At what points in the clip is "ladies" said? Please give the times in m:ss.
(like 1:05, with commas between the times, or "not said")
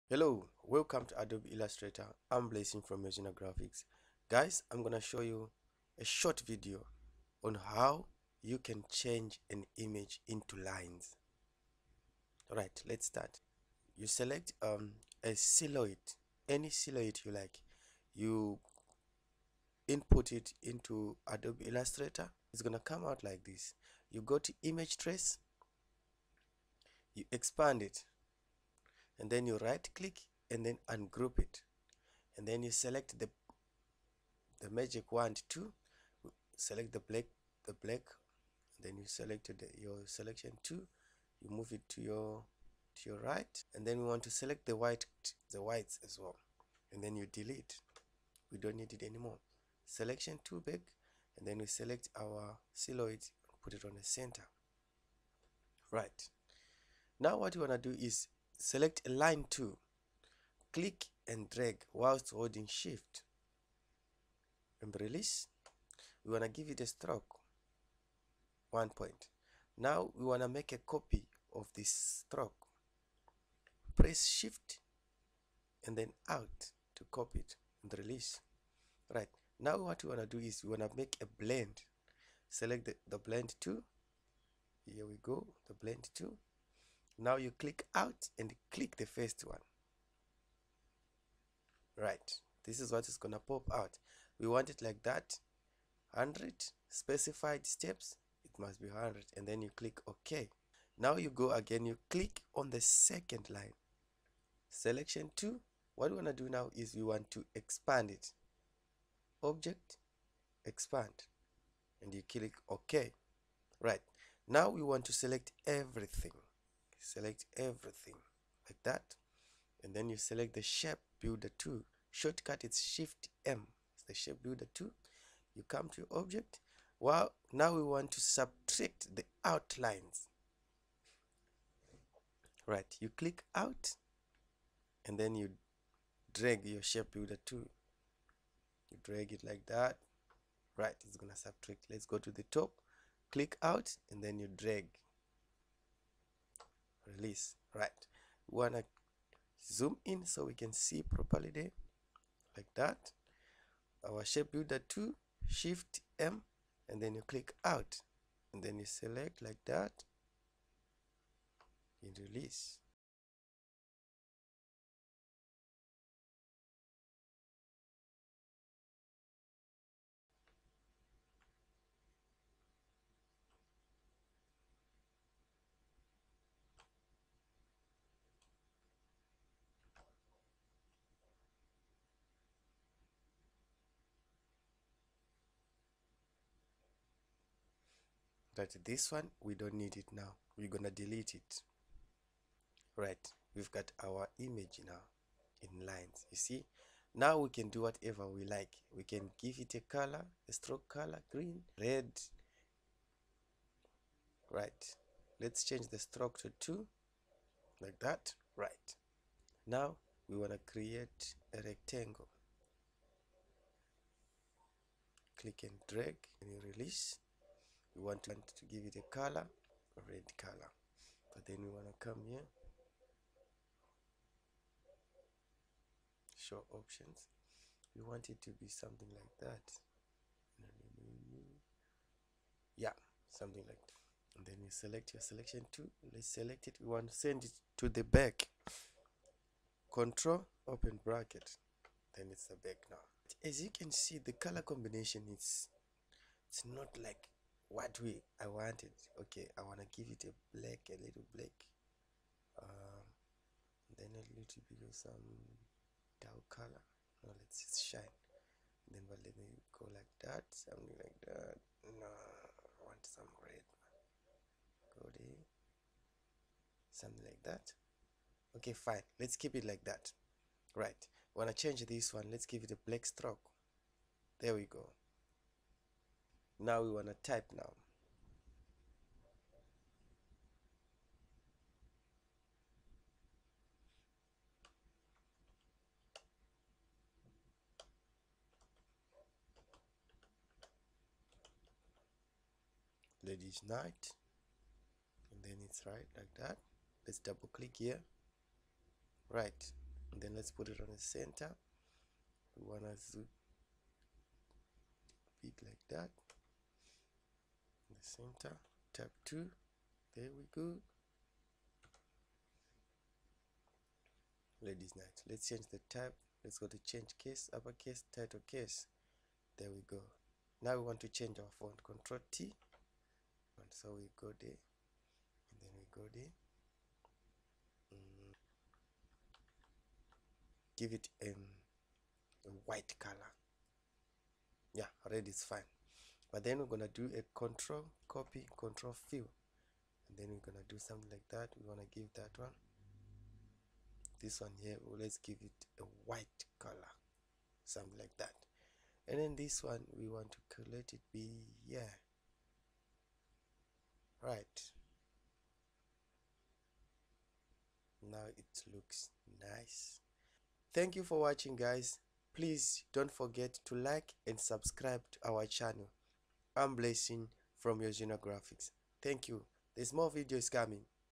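4:53, 5:14.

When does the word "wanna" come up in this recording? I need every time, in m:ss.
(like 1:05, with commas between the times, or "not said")
4:09, 4:31.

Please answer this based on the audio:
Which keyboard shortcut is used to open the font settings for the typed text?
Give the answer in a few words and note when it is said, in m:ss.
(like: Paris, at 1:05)
Control T, at 5:21.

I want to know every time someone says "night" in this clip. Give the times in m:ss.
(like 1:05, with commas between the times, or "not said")
4:53, 5:14.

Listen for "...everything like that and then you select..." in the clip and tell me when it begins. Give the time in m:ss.
1:57.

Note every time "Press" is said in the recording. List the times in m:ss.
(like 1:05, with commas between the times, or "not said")
1:13.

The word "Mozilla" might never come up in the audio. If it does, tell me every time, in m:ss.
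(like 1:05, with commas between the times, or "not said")
0:03.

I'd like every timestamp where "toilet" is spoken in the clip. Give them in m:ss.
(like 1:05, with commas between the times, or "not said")
not said.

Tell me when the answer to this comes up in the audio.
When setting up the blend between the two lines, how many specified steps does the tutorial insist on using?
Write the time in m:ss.
1:36.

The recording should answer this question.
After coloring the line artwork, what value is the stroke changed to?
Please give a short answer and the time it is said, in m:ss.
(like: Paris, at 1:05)
2, at 3:25.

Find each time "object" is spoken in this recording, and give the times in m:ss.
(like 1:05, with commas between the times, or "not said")
1:49, 2:06.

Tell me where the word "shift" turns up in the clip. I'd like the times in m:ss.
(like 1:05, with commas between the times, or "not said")
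1:02, 1:14, 2:02, 2:35.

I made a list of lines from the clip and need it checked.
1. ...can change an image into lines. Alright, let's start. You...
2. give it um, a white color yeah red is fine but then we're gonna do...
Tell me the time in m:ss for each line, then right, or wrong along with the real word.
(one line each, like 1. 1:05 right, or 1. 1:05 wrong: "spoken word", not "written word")
1. 0:08 right
2. 5:30 right.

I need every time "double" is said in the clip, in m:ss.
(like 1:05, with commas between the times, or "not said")
4:57.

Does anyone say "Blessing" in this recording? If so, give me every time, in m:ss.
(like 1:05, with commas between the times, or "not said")
0:02, 6:06.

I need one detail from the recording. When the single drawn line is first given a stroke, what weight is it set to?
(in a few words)
1 point.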